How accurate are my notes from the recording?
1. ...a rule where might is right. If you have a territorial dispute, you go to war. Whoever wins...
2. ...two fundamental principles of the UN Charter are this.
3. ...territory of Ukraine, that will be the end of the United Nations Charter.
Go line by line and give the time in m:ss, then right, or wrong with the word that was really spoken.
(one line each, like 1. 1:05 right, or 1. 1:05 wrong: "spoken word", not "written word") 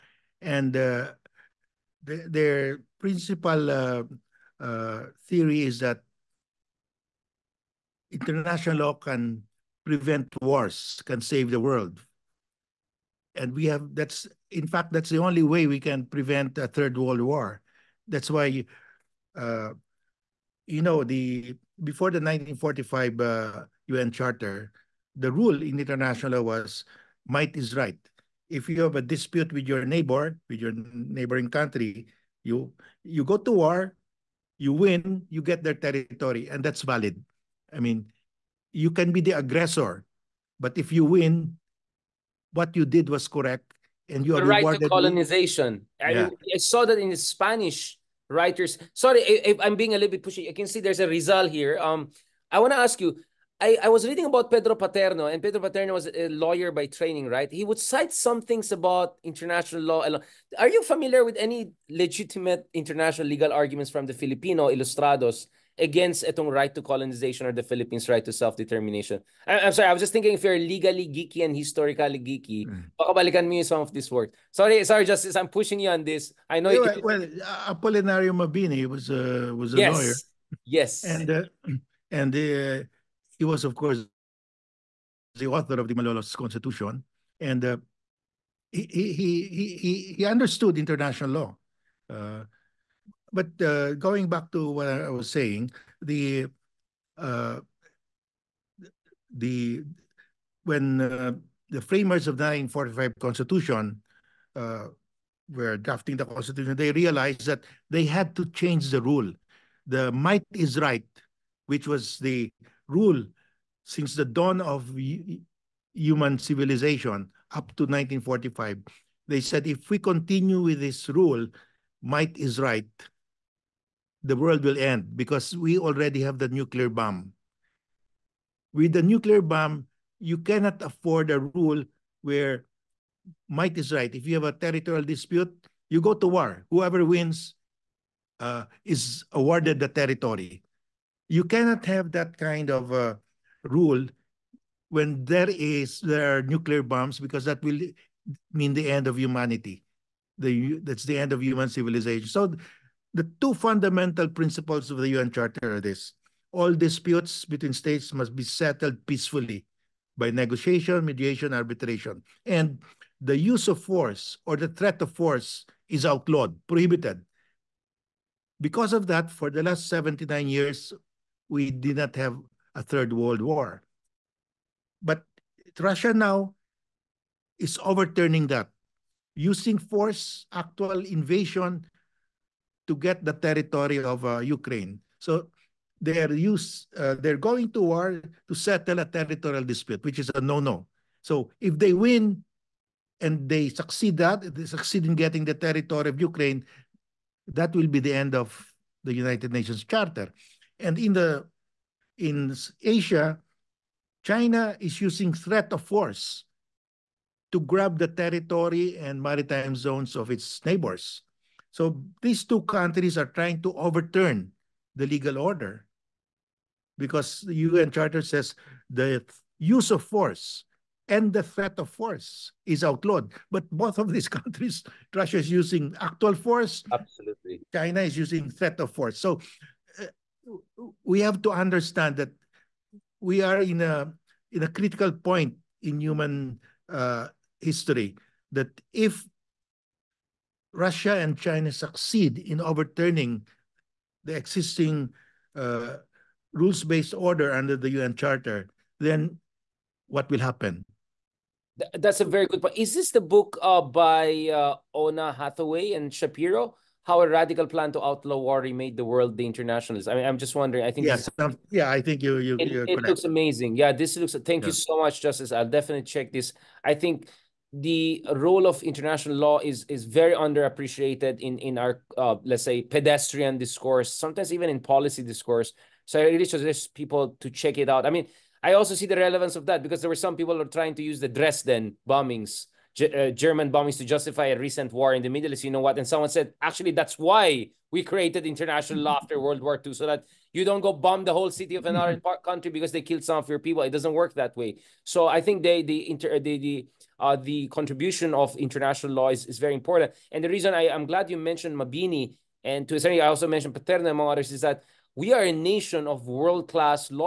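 1. 2:11 right
2. 2:33 right
3. 3:15 right.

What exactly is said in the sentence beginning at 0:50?
I can see there's a Rizal here.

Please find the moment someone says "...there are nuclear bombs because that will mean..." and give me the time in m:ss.
2:25.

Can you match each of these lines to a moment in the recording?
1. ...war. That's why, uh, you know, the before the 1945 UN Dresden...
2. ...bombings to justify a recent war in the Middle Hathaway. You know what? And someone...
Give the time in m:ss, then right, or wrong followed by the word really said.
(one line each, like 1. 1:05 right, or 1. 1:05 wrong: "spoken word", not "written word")
1. 0:17 wrong: "Charter", not "Dresden"
2. 4:43 wrong: "East", not "Hathaway".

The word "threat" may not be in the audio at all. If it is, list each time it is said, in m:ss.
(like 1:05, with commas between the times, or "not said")
2:44, 3:25, 3:41, 3:48.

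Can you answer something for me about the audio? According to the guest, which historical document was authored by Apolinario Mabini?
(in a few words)
Malolos Constitution.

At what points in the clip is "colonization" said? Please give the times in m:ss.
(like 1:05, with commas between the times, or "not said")
0:44, 1:06.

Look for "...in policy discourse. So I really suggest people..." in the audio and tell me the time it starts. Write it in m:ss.
4:34.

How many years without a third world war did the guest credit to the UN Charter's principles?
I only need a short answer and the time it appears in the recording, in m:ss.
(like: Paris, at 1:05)
79, at 2:49.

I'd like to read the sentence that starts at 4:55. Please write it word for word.
So I think they, the inter, the, the, uh, the contribution of international law is, is very important.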